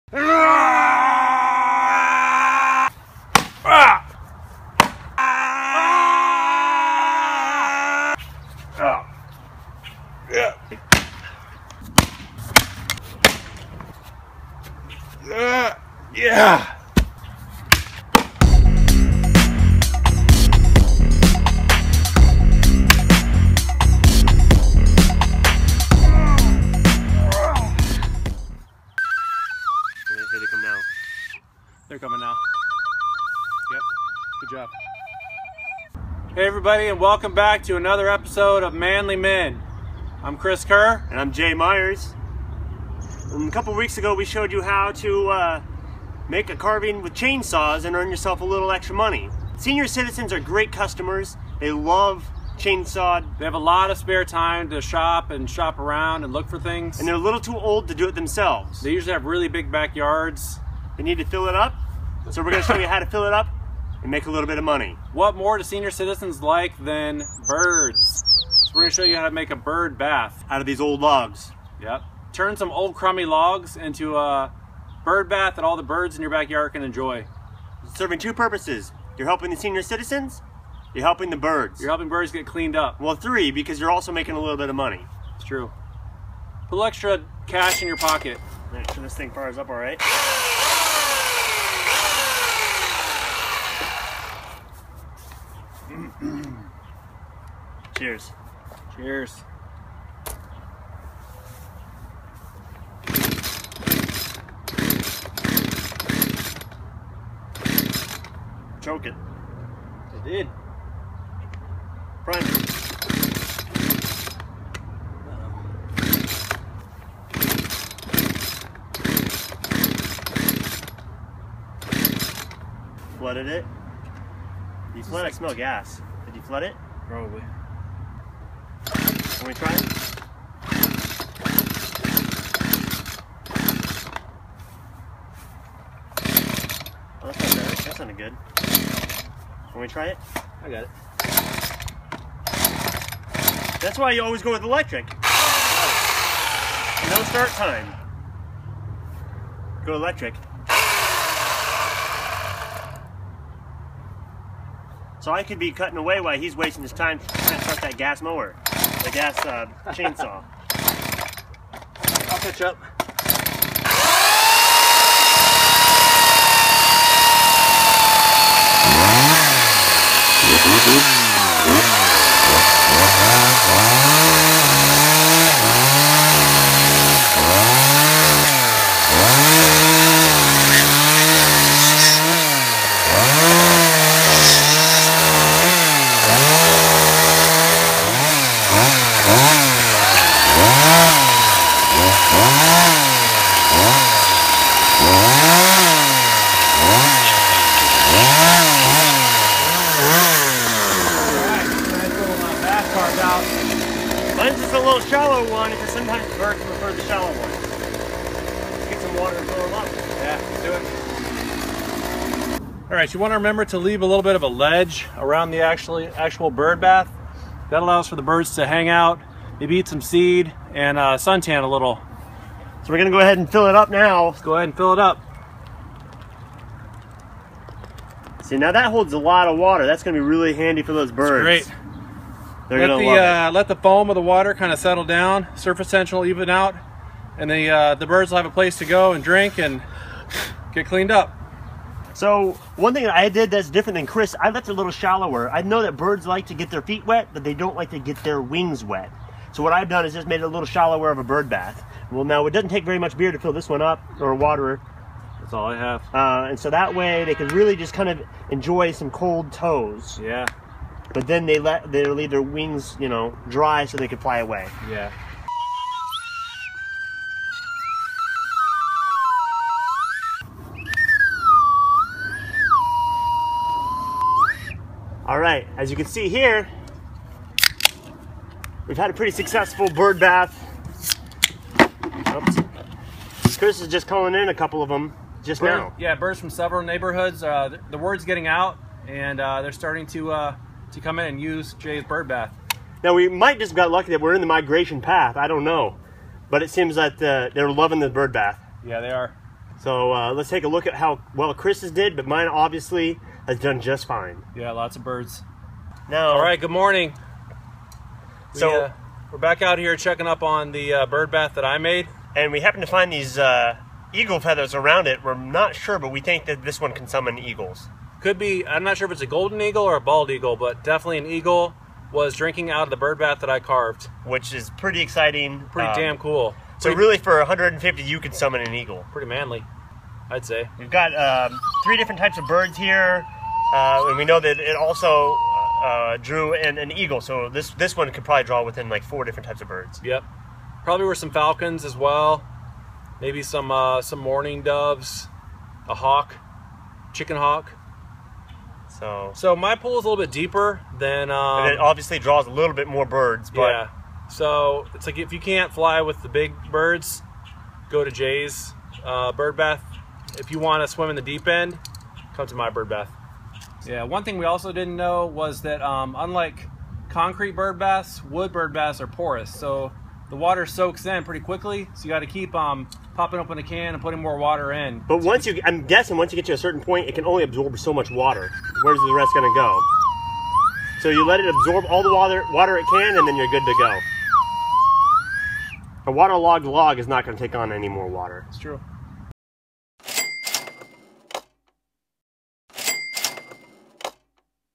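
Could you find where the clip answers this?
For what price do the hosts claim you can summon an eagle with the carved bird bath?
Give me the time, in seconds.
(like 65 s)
327 s.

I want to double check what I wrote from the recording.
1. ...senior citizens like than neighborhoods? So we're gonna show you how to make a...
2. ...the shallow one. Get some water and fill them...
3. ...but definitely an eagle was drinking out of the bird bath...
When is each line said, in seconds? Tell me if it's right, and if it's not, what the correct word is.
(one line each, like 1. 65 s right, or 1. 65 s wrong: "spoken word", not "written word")
1. 65 s wrong: "birds", not "neighborhoods"
2. 206 s right
3. 320 s right.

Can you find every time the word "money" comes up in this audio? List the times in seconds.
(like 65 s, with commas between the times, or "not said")
48 s, 64 s, 84 s.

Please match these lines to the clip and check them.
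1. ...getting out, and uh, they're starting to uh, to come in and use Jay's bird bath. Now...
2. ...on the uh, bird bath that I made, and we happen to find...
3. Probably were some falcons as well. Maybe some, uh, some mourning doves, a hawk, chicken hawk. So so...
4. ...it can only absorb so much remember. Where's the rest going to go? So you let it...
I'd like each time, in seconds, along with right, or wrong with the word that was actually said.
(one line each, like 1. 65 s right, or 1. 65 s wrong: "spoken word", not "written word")
1. 288 s right
2. 310 s right
3. 340 s right
4. 377 s wrong: "water", not "remember".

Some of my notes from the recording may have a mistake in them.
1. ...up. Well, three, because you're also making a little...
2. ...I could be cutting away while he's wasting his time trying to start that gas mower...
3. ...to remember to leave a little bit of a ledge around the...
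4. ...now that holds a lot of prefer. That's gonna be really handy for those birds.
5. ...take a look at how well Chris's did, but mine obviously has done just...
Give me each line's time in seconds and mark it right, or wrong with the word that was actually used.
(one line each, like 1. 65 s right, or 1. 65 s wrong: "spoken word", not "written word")
1. 82 s right
2. 155 s right
3. 213 s right
4. 228 s wrong: "water", not "prefer"
5. 300 s right.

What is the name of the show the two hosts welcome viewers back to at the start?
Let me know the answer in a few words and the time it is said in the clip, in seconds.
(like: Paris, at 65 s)
Manly Men, at 38 s.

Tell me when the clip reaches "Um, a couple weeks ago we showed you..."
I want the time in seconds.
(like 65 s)
43 s.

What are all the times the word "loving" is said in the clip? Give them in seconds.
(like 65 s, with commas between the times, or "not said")
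297 s.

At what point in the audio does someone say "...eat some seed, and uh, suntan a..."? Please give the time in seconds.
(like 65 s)
219 s.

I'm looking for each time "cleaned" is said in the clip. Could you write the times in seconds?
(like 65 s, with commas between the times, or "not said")
82 s, 240 s.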